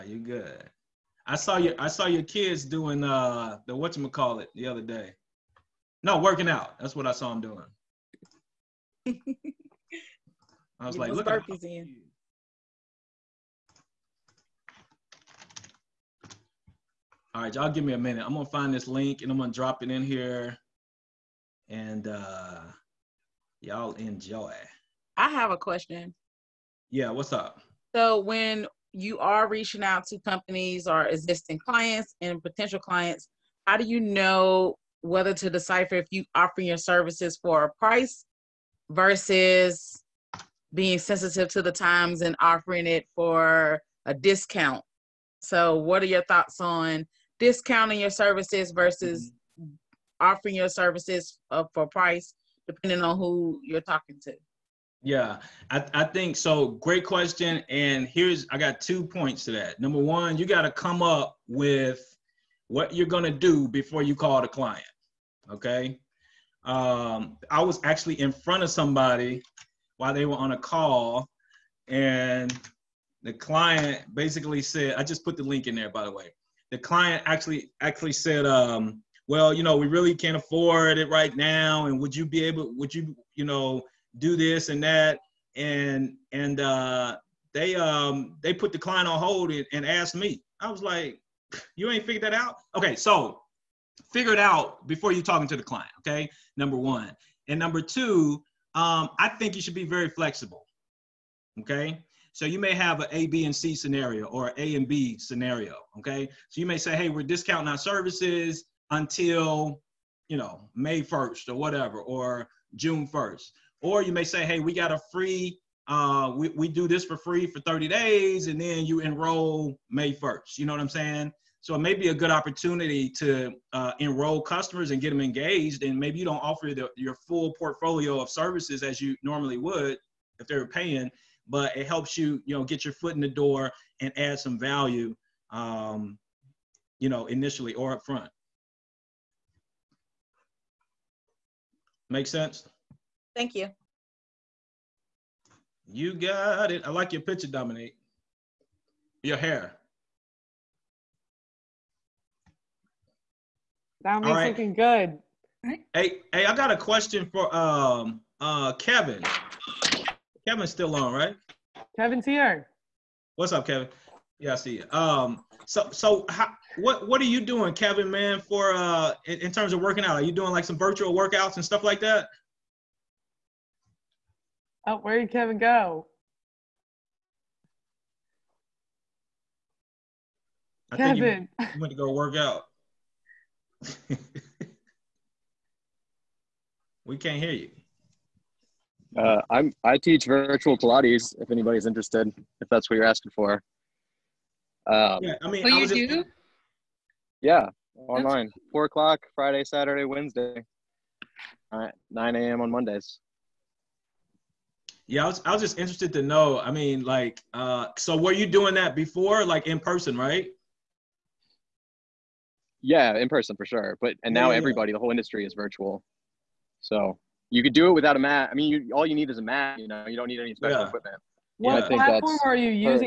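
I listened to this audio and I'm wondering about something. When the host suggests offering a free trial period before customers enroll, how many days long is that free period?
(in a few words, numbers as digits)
30.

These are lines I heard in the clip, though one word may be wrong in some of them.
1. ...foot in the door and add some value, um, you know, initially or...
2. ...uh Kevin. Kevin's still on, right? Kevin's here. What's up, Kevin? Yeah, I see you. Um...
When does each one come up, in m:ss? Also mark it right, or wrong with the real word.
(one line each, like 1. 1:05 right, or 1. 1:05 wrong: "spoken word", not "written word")
1. 2:12 right
2. 2:38 right.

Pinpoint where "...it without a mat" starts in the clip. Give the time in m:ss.
3:37.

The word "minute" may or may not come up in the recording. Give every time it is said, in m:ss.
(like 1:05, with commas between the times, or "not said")
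0:17.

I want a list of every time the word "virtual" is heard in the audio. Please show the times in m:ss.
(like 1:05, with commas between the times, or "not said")
2:50, 3:10, 3:35.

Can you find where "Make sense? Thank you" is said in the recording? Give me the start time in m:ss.
2:22.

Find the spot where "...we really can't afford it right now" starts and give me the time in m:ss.
1:19.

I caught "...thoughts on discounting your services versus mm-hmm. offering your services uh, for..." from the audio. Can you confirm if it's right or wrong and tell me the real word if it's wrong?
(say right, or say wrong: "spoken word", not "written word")
right.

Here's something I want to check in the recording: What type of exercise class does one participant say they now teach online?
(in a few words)
Pilates.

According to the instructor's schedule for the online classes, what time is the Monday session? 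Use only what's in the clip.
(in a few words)
9 a.m.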